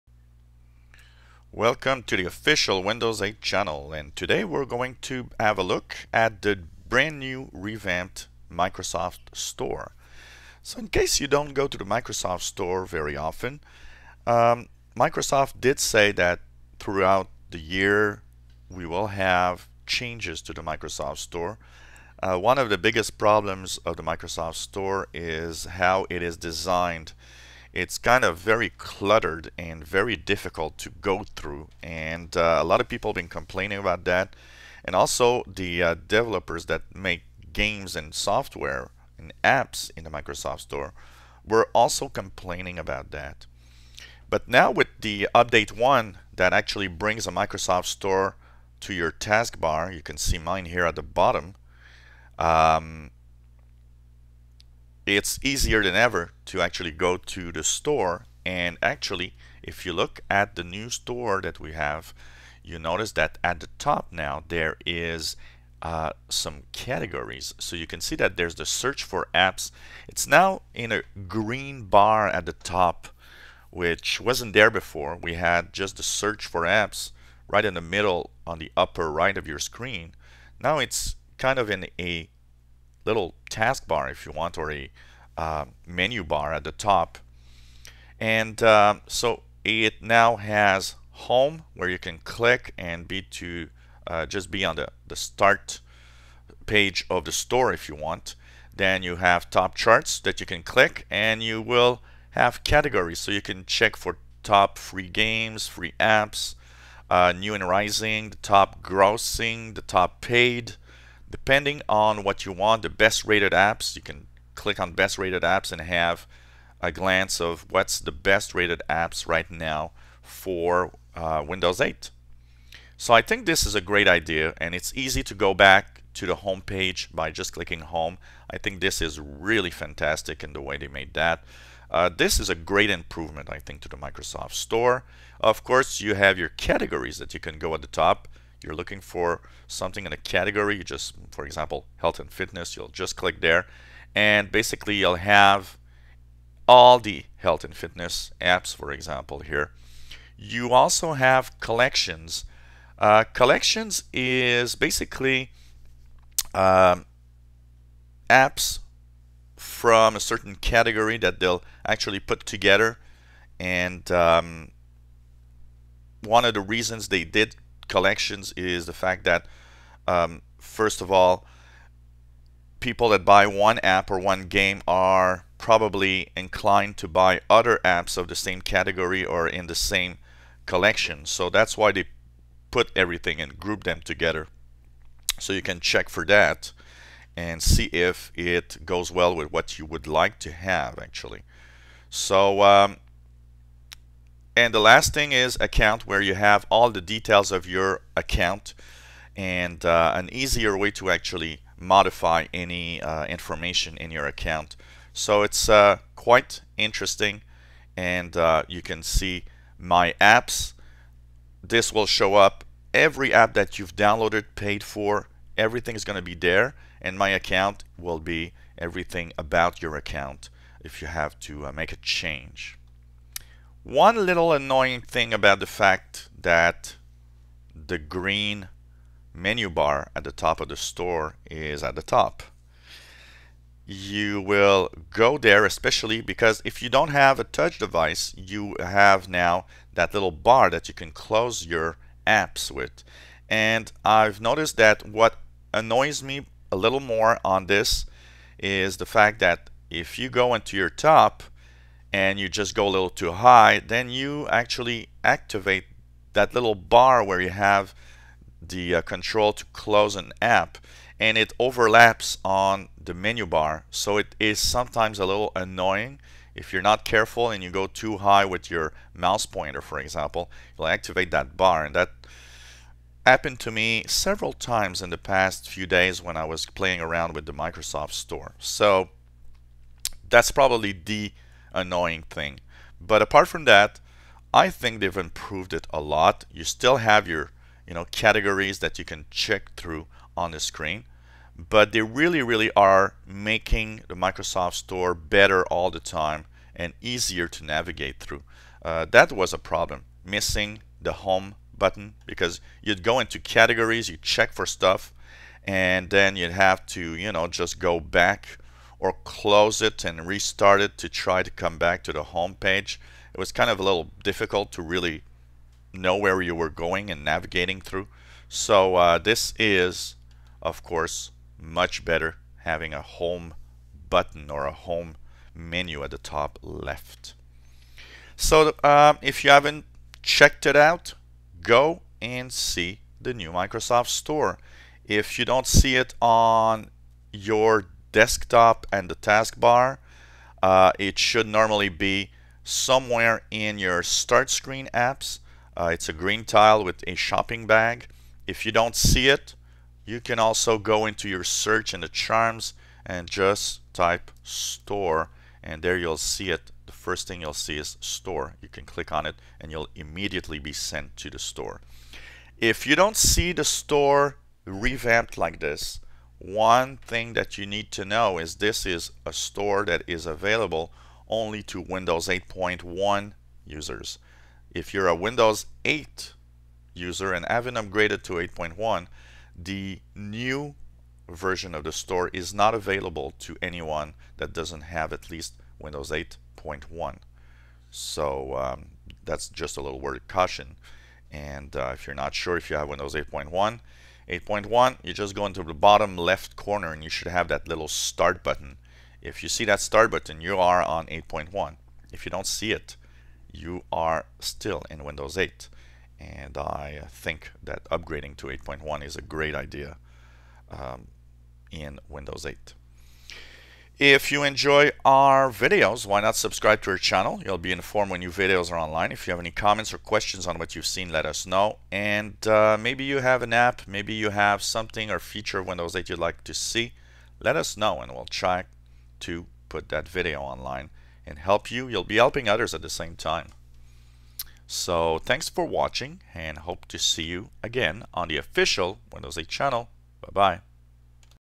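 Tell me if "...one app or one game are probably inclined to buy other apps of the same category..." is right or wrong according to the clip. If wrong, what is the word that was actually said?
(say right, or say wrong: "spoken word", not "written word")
right.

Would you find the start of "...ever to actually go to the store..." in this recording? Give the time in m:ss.
0:55.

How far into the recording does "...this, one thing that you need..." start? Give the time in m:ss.
6:05.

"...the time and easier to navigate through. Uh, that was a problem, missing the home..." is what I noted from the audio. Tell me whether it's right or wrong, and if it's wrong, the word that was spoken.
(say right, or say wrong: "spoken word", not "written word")
right.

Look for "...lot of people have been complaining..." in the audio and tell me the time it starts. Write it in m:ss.
0:32.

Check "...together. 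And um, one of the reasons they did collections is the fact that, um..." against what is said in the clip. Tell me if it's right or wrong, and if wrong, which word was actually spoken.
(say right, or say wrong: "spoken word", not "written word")
right.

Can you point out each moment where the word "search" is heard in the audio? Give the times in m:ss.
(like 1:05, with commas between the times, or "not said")
1:08, 1:16, 5:51.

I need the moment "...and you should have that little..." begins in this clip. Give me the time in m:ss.
6:36.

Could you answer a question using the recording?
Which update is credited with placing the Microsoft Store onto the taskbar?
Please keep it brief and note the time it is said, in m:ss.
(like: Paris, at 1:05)
Update 1, at 0:45.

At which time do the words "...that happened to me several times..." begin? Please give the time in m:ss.
4:31.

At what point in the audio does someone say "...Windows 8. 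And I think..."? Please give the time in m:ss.
6:45.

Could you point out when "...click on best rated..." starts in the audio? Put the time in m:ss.
1:54.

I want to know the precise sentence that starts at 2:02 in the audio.
So I think this is a great idea and it's easy to go back to the home page by just clicking home.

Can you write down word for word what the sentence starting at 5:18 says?
So uh, this is, of course, much better having a home button or a home menu at the top left.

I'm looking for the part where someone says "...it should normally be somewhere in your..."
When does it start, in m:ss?
5:40.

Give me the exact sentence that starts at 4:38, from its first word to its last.
So that's probably the annoying thing.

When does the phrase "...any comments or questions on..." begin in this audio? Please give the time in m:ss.
6:59.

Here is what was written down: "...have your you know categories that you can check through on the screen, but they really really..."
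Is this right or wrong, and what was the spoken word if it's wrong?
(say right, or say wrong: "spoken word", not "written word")
right.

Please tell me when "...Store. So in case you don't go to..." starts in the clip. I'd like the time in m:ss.
0:09.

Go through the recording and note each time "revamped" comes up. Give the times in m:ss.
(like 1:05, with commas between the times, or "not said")
0:07, 6:04.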